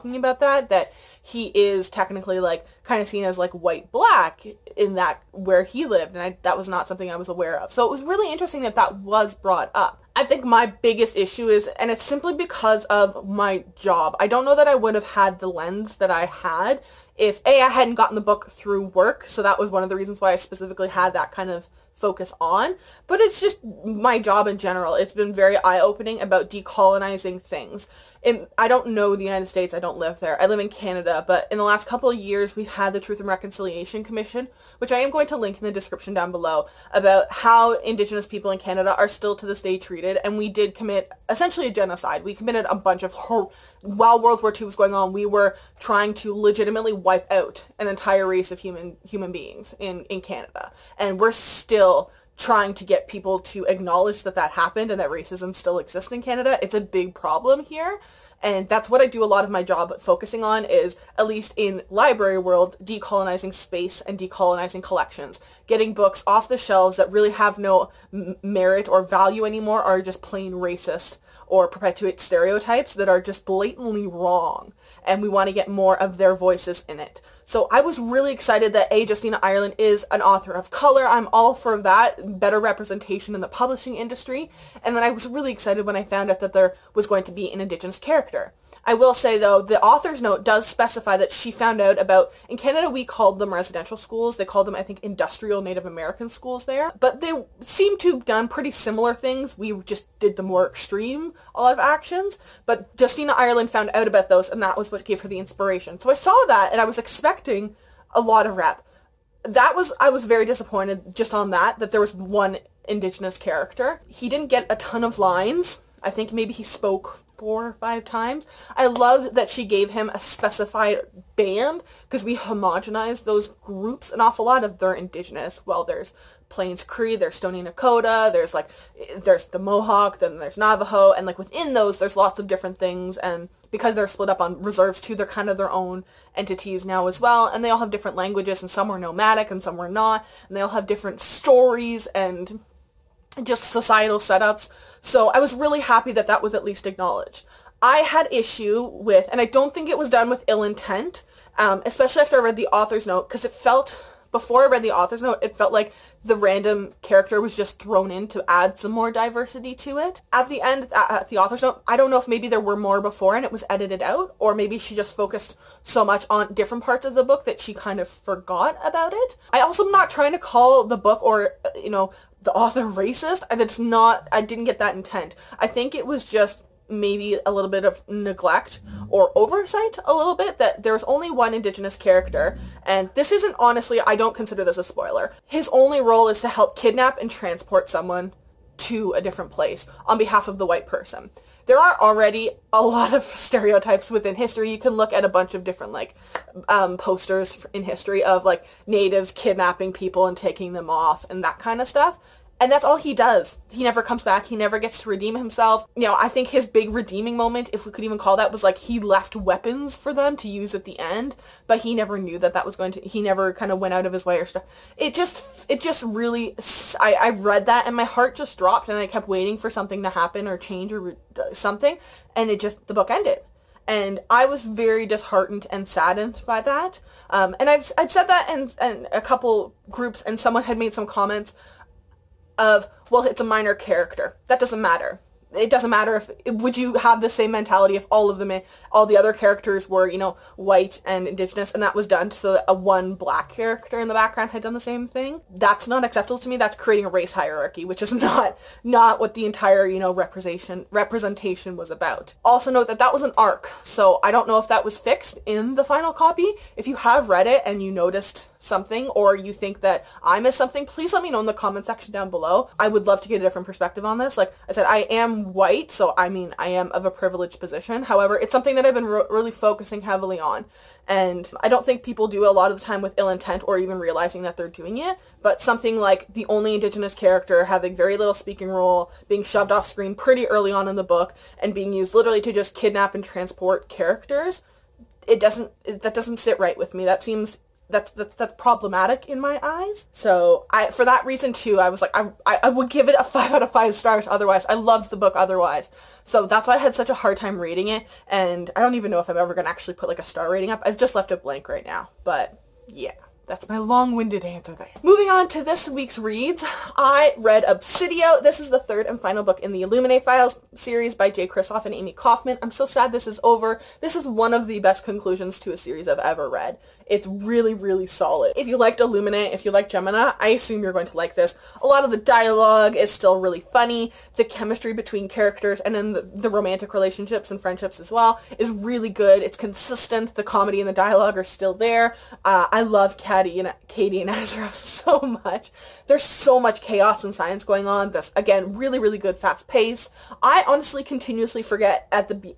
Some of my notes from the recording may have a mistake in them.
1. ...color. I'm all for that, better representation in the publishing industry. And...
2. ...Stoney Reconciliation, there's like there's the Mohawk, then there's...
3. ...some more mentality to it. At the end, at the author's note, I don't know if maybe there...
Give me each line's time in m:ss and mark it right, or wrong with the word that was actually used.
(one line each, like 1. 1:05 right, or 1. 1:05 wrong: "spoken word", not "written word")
1. 1:20 right
2. 2:07 wrong: "Nakoda", not "Reconciliation"
3. 2:38 wrong: "diversity", not "mentality".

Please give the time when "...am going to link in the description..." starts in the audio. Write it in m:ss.
0:34.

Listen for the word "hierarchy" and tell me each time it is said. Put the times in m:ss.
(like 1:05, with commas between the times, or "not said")
4:07.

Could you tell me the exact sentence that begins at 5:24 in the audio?
The chemistry between characters and then the, the romantic relationships and friendships as well is really good.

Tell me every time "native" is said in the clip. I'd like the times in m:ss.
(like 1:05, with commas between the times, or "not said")
1:35, 3:18.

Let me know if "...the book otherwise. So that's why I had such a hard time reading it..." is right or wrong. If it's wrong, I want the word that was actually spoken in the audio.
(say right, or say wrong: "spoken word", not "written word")
right.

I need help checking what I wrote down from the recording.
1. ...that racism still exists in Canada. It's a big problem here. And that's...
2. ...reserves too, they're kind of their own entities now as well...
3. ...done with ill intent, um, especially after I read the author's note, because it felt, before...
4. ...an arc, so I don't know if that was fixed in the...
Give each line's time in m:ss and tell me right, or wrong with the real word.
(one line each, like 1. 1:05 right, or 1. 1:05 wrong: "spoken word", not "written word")
1. 0:54 right
2. 2:14 right
3. 2:30 right
4. 4:13 right.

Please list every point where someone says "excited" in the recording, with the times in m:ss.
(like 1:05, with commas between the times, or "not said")
1:18, 1:25.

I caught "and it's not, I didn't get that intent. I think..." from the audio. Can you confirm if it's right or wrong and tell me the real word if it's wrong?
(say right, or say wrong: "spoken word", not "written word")
right.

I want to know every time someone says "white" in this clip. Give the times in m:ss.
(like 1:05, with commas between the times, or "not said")
0:03, 3:10, 4:00, 4:25.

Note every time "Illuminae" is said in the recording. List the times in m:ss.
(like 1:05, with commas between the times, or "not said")
5:09, 5:18.